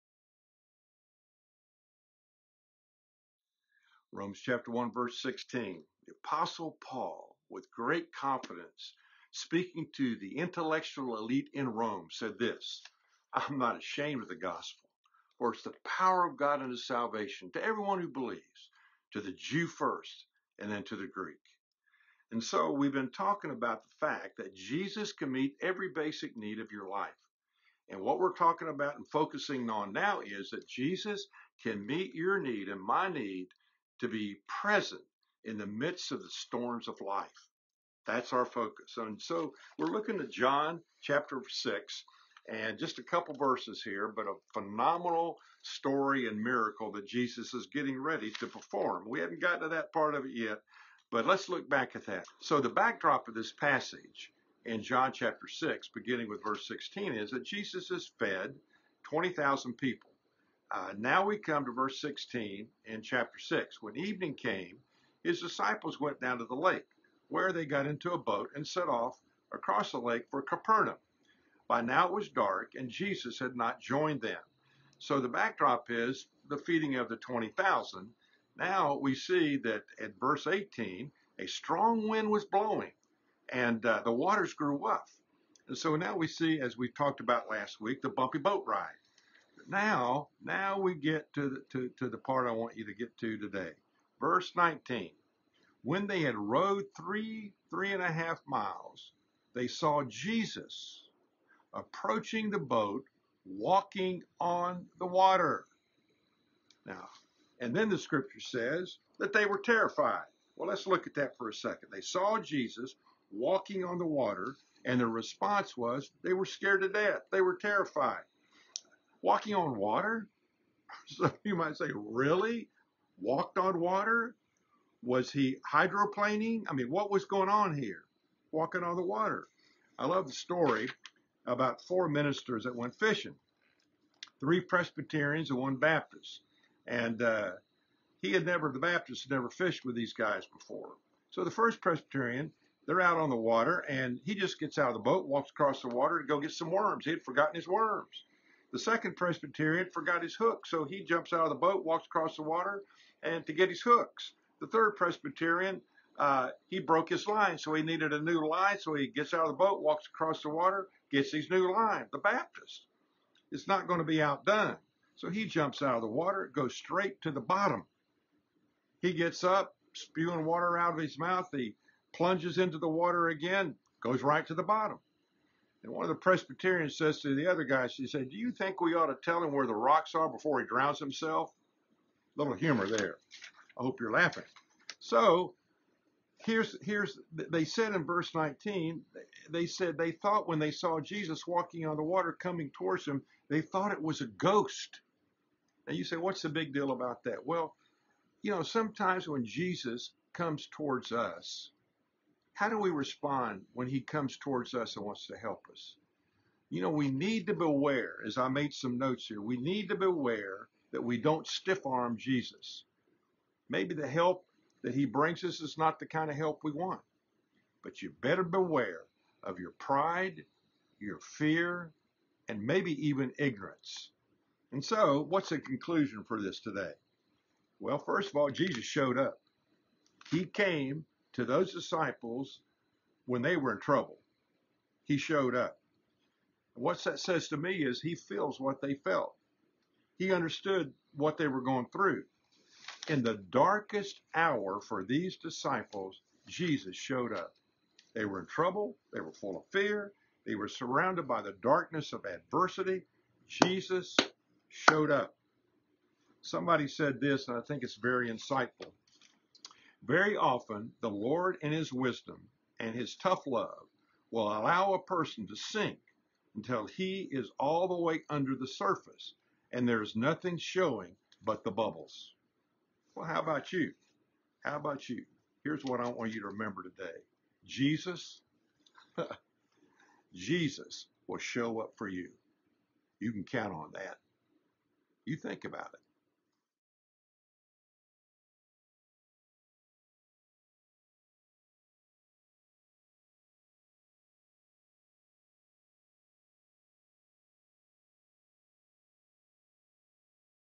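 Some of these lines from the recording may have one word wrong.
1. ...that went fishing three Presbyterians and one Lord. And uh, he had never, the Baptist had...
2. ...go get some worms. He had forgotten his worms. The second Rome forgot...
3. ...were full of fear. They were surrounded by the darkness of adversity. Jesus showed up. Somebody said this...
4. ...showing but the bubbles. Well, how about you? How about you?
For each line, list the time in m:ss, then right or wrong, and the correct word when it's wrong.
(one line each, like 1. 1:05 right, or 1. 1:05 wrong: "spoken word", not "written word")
1. 2:12 wrong: "Baptist", not "Lord"
2. 2:26 wrong: "Presbyterian", not "Rome"
3. 4:09 right
4. 4:30 right.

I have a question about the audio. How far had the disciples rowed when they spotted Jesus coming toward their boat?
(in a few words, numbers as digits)
three and a half miles.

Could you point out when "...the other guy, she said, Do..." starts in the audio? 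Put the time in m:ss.
2:57.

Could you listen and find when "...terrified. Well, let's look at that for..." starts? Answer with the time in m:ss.
1:49.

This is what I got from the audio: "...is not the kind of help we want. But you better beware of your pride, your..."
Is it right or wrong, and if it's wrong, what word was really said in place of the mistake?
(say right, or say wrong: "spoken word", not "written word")
right.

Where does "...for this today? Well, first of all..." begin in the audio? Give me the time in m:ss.
3:46.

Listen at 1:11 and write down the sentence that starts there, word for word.
By now it was dark, and Jesus had not joined them.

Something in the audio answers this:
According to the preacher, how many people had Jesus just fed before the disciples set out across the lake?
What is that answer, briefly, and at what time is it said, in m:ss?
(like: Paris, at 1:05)
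20,000, at 0:59.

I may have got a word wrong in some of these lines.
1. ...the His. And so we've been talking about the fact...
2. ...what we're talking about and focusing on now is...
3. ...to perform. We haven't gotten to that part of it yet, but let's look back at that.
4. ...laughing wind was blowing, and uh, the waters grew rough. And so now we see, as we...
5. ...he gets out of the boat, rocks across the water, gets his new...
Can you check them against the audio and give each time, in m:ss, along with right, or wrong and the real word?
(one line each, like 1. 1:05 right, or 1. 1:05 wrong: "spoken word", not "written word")
1. 0:20 wrong: "Greek", not "His"
2. 0:28 right
3. 0:48 right
4. 1:21 wrong: "strong", not "laughing"
5. 2:38 wrong: "walks", not "rocks".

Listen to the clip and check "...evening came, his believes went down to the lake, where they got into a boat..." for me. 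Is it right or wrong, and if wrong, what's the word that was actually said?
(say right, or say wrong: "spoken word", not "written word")
wrong: "disciples", not "believes".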